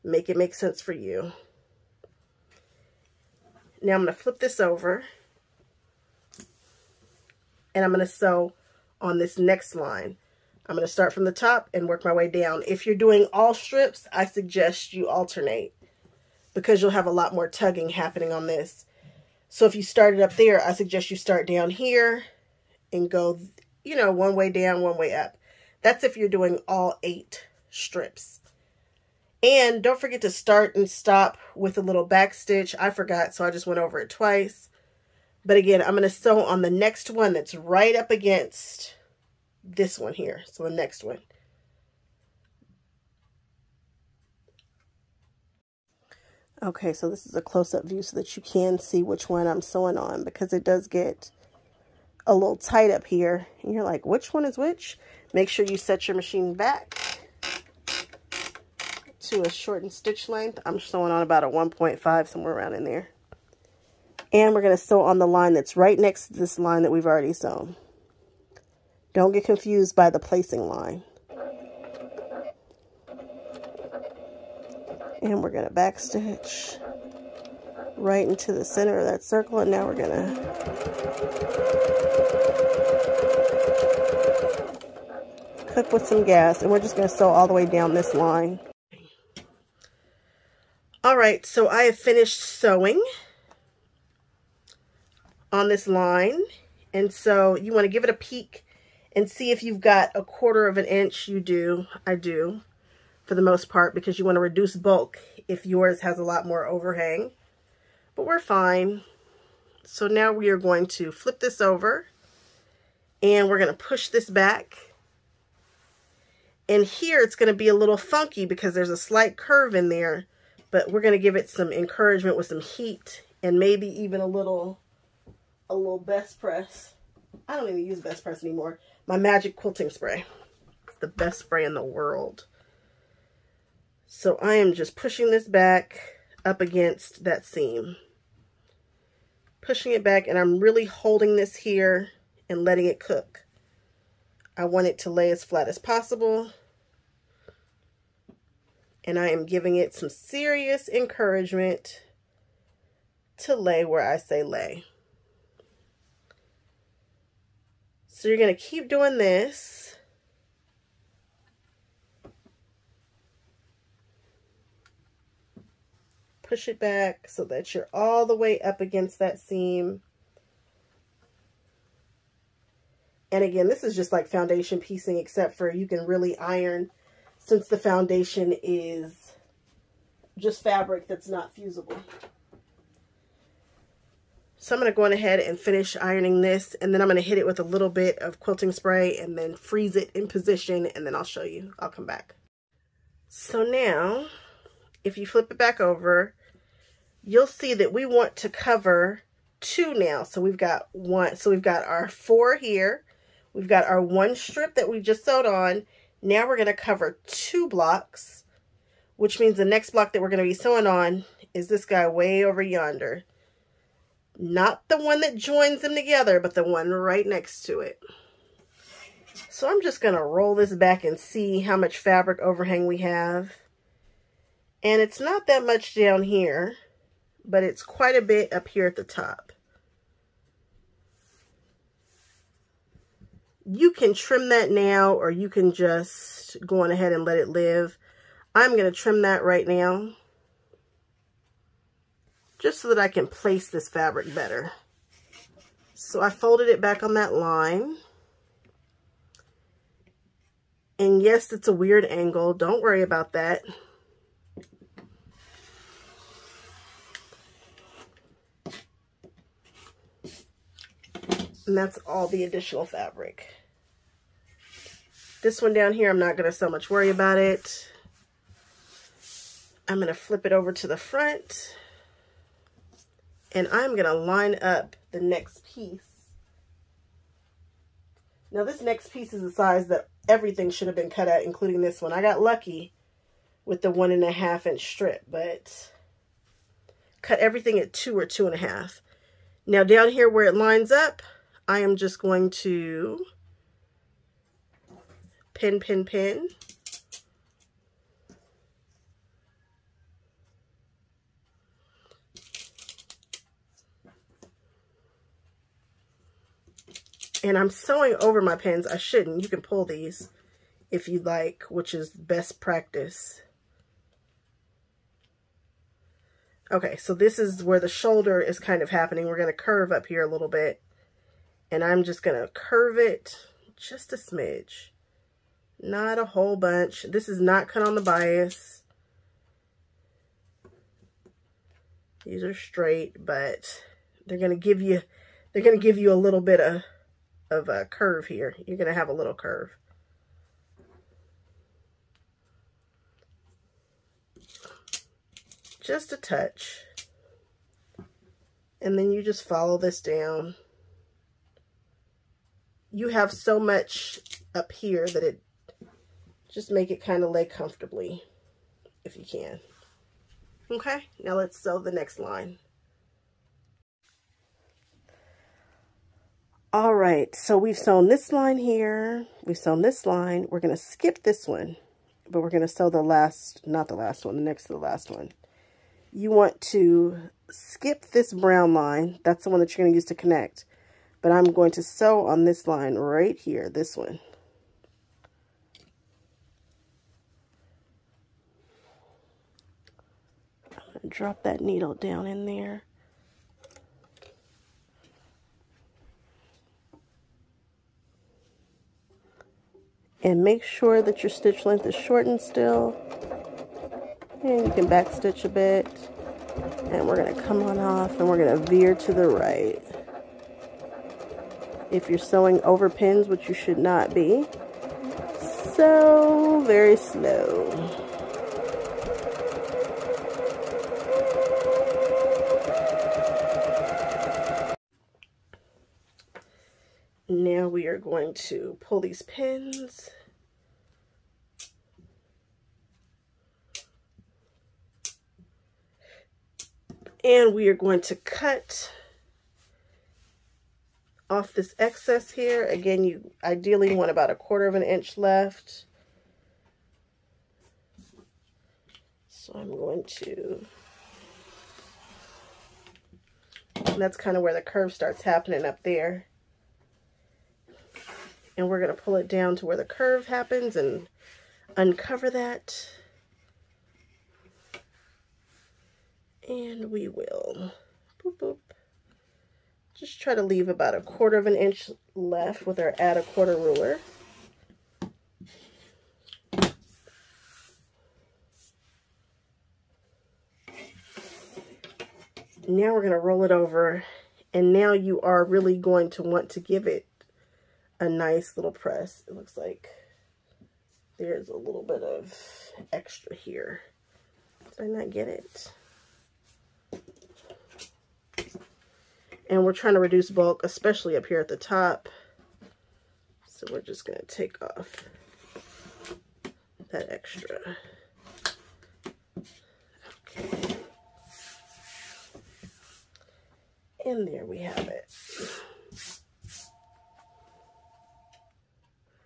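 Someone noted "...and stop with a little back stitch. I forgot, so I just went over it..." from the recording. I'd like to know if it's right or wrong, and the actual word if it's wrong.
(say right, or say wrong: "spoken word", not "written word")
right.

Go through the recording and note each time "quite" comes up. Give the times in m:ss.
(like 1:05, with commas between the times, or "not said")
3:47.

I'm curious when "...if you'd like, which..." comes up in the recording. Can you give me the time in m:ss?
5:10.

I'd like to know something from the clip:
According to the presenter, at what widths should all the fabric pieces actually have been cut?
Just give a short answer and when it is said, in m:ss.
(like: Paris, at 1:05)
2 or 2 and a half, at 4:47.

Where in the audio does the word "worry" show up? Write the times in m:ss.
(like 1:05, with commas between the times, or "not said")
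4:12, 4:26.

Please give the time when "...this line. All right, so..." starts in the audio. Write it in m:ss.
1:27.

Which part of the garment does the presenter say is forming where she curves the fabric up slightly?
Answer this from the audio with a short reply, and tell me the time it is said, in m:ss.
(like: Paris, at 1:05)
shoulder, at 5:17.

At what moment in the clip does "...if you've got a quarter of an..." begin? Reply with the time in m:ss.
1:39.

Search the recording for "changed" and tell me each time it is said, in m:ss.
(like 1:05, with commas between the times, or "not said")
not said.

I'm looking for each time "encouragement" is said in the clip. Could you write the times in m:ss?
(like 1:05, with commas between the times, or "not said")
2:01, 2:30.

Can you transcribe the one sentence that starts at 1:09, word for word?
Don't get confused by the placing line.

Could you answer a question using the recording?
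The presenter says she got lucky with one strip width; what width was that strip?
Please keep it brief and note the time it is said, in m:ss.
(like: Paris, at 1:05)
one and a half inch, at 4:43.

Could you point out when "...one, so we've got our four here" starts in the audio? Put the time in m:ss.
3:20.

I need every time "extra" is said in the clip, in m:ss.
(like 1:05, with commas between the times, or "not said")
8:12, 8:27.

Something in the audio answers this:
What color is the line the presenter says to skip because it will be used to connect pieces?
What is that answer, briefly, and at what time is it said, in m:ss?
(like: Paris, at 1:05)
brown, at 6:18.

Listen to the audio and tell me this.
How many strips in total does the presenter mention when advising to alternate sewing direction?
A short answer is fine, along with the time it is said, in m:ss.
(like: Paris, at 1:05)
8, at 0:27.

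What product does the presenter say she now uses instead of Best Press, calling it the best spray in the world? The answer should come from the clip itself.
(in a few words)
Magic Quilting Spray.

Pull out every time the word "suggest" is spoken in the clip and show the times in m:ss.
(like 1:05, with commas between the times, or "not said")
0:14, 0:20.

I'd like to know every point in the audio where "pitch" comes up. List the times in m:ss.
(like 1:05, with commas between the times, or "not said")
not said.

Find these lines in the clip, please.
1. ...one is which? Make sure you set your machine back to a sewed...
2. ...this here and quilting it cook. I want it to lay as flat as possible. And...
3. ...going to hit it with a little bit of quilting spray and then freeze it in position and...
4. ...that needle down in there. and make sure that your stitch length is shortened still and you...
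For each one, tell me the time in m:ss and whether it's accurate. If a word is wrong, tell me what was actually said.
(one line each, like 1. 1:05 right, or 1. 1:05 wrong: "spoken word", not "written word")
1. 0:54 wrong: "shortened", not "sewed"
2. 2:21 wrong: "letting", not "quilting"
3. 3:07 right
4. 6:31 right.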